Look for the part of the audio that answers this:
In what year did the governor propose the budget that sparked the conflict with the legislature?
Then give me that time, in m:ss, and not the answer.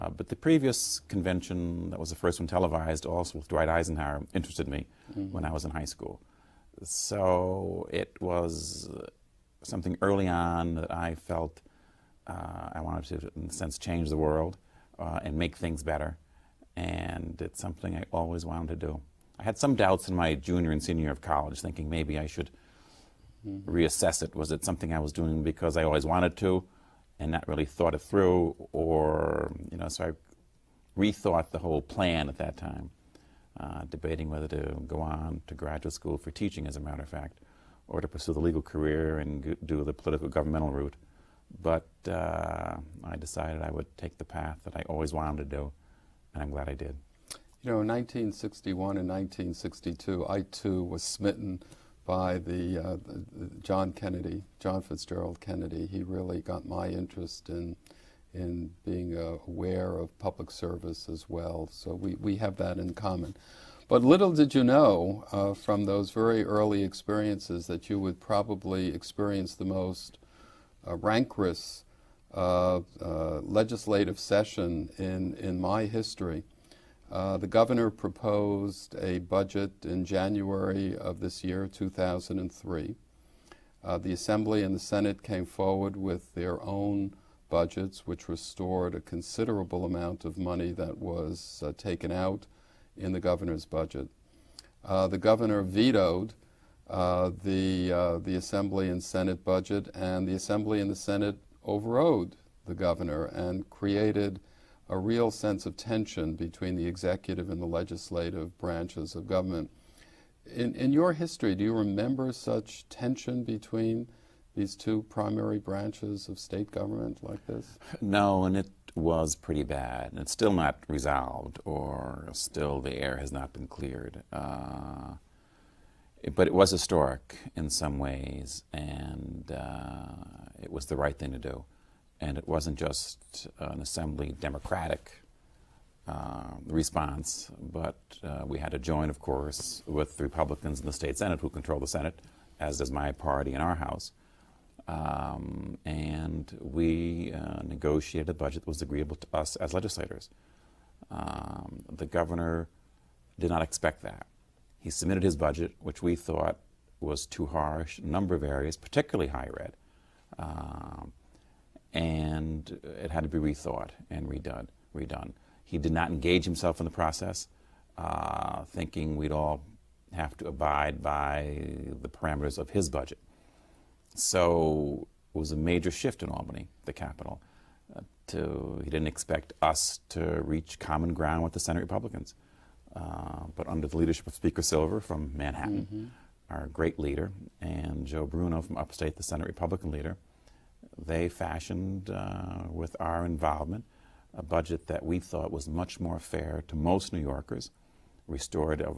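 1:21.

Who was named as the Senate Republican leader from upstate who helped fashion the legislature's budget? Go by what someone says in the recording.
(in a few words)
Joe Bruno.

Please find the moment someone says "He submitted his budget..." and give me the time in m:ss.
2:34.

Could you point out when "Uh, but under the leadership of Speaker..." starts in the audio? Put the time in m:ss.
3:02.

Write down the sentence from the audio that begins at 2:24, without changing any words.
Um, and we uh, negotiated a budget that was agreeable to us as legislators.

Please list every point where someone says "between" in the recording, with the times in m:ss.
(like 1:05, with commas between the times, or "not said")
1:46, 1:53.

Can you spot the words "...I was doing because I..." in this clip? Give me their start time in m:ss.
0:24.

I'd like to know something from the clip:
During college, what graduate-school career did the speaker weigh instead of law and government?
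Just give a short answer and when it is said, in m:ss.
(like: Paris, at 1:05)
teaching, at 0:36.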